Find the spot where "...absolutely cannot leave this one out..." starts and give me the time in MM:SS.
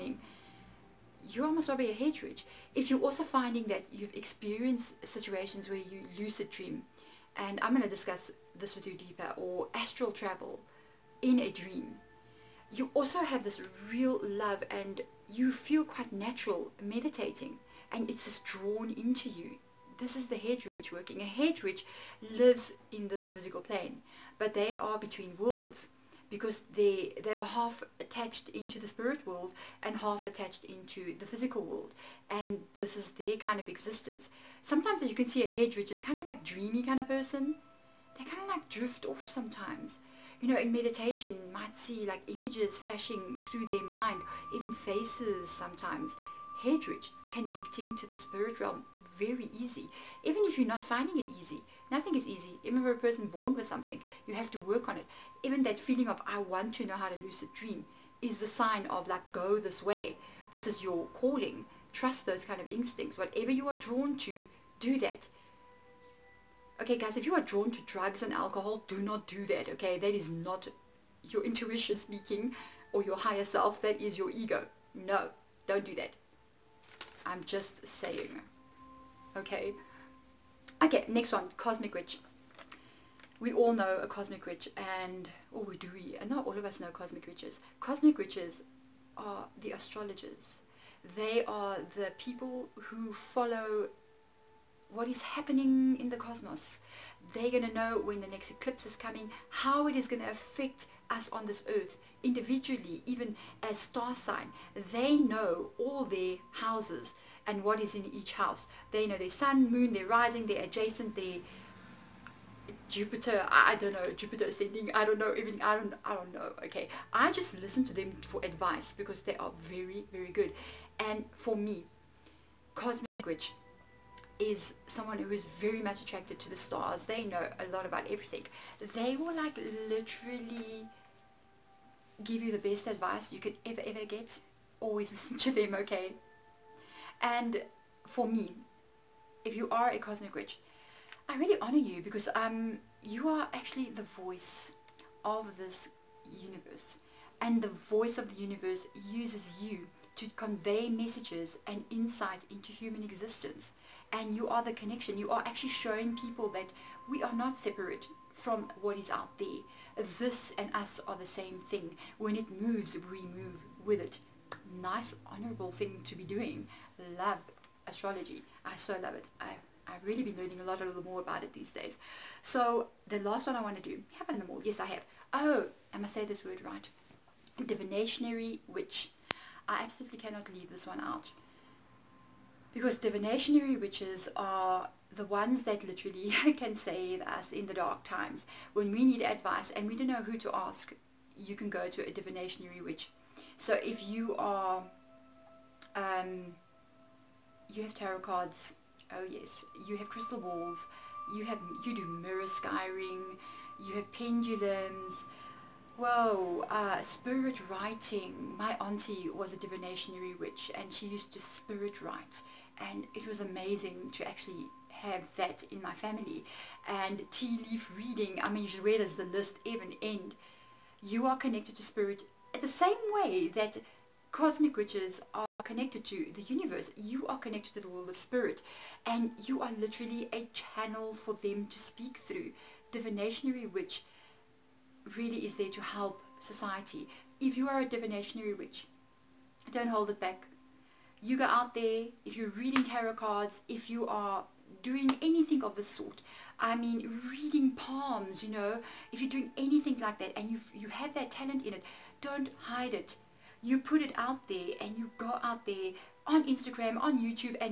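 02:59.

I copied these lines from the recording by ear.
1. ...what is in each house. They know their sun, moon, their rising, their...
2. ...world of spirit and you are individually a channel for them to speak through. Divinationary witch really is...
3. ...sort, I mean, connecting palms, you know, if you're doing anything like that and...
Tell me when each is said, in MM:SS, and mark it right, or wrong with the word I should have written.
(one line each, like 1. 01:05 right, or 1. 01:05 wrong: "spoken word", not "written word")
1. 01:47 right
2. 03:47 wrong: "literally", not "individually"
3. 04:05 wrong: "reading", not "connecting".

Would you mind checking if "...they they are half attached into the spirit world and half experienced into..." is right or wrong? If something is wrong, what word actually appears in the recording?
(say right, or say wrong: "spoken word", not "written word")
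wrong: "attached", not "experienced".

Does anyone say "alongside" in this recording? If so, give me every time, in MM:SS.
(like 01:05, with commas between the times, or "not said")
not said.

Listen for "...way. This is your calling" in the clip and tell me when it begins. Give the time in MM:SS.
00:59.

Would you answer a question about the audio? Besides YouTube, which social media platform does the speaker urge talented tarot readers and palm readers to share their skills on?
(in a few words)
Instagram.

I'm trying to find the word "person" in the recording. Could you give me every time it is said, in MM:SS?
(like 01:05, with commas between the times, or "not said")
00:37, 00:52.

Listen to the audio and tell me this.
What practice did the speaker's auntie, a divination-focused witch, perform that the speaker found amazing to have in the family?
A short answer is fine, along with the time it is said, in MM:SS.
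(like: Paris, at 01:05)
Spirit writing, at 03:31.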